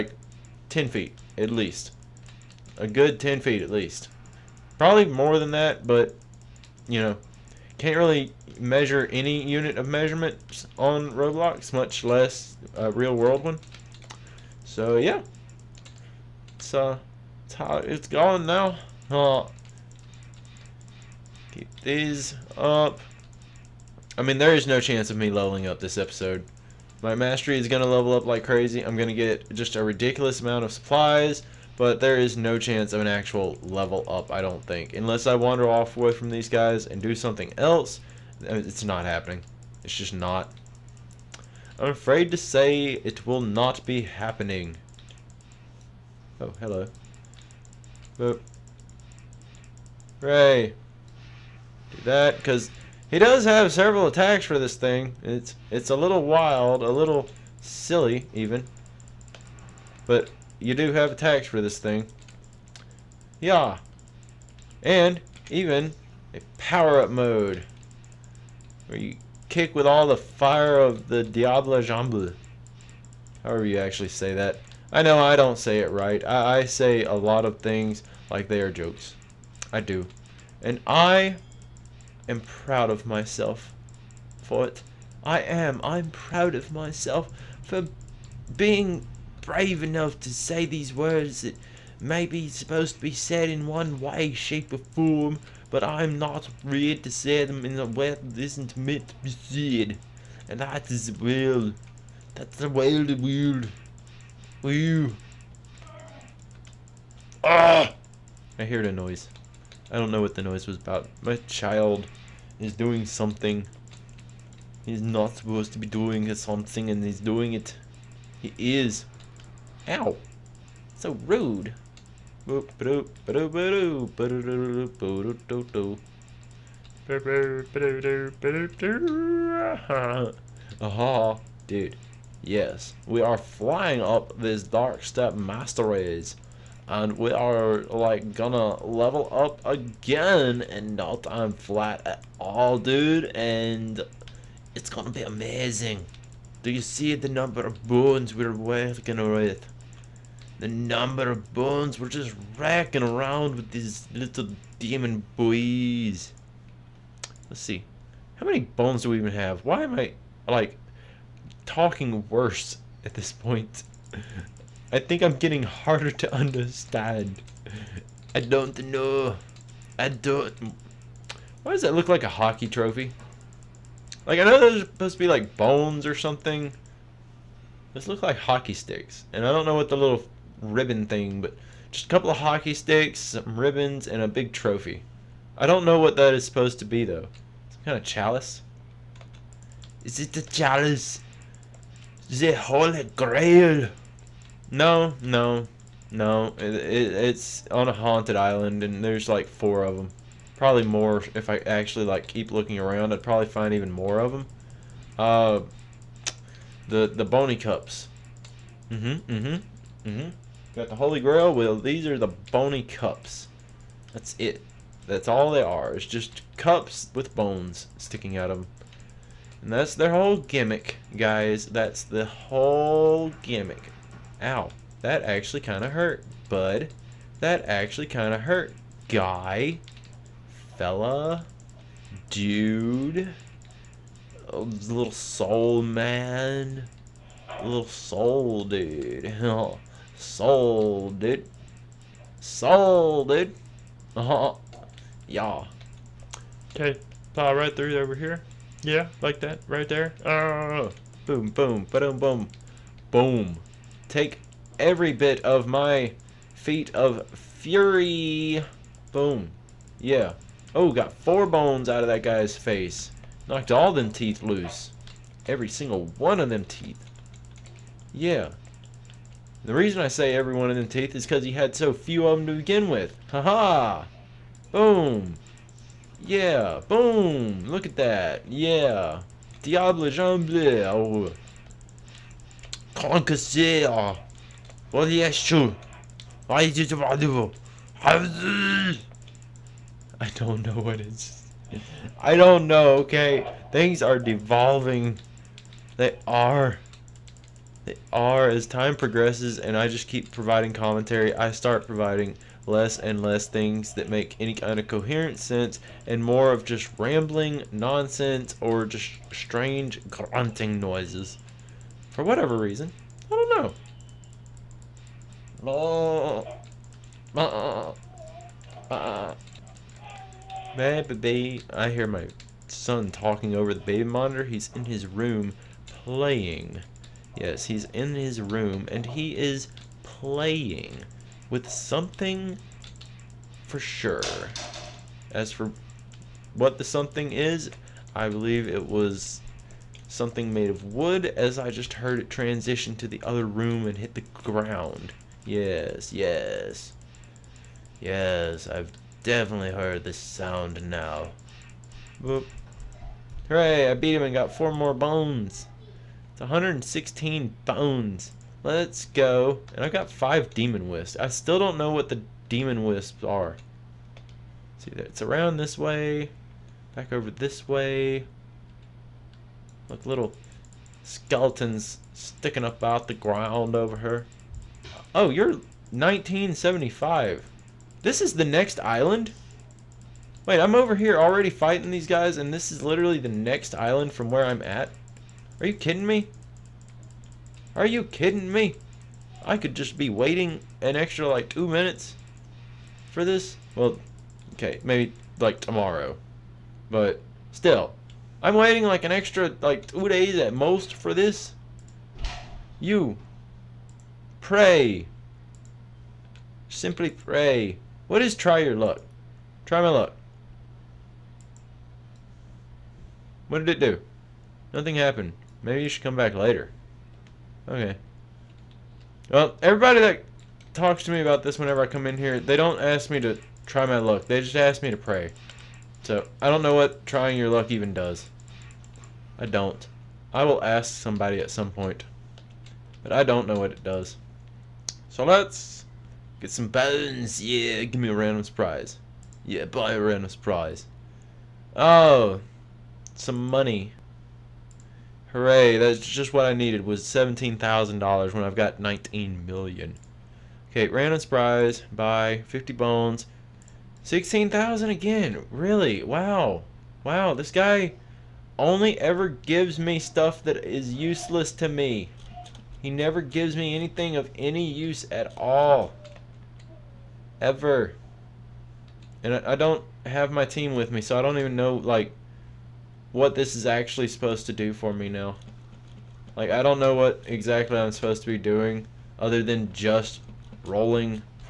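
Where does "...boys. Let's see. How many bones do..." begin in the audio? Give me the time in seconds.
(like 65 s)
155 s.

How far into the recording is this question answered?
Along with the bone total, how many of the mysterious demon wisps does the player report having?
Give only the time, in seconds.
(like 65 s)
360 s.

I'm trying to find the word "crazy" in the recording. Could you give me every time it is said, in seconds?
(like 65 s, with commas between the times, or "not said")
28 s.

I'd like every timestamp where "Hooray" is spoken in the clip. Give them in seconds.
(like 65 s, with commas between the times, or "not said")
353 s, 445 s.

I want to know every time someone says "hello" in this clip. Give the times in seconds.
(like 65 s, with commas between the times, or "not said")
46 s.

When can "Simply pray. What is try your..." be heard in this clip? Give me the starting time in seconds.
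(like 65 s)
406 s.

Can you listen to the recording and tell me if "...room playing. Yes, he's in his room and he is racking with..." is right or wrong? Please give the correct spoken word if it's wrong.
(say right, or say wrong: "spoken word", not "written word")
wrong: "playing", not "racking".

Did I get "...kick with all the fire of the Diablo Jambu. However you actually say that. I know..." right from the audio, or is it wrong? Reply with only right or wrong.
right.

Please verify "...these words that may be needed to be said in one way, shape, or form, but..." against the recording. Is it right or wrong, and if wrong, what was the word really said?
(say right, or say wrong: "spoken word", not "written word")
wrong: "supposed", not "needed".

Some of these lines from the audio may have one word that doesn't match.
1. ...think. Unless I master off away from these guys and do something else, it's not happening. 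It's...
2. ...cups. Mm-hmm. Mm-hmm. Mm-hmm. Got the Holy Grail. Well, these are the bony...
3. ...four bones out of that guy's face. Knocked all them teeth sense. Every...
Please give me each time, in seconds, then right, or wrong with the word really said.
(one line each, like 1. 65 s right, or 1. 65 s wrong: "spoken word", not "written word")
1. 34 s wrong: "wander", not "master"
2. 207 s right
3. 261 s wrong: "loose", not "sense".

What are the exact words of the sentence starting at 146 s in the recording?
Do you see the number of bones we're working with?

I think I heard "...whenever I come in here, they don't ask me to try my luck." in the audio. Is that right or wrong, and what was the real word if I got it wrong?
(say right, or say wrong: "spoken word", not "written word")
right.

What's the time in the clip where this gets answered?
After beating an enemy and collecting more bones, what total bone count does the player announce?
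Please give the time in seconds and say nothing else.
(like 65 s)
356 s.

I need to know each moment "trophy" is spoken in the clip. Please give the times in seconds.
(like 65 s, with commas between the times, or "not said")
172 s, 184 s.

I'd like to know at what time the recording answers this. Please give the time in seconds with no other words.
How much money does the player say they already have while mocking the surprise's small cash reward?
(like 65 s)
448 s.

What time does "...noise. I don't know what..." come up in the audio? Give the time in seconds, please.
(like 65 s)
108 s.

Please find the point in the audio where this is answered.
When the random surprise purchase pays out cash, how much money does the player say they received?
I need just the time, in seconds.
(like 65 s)
447 s.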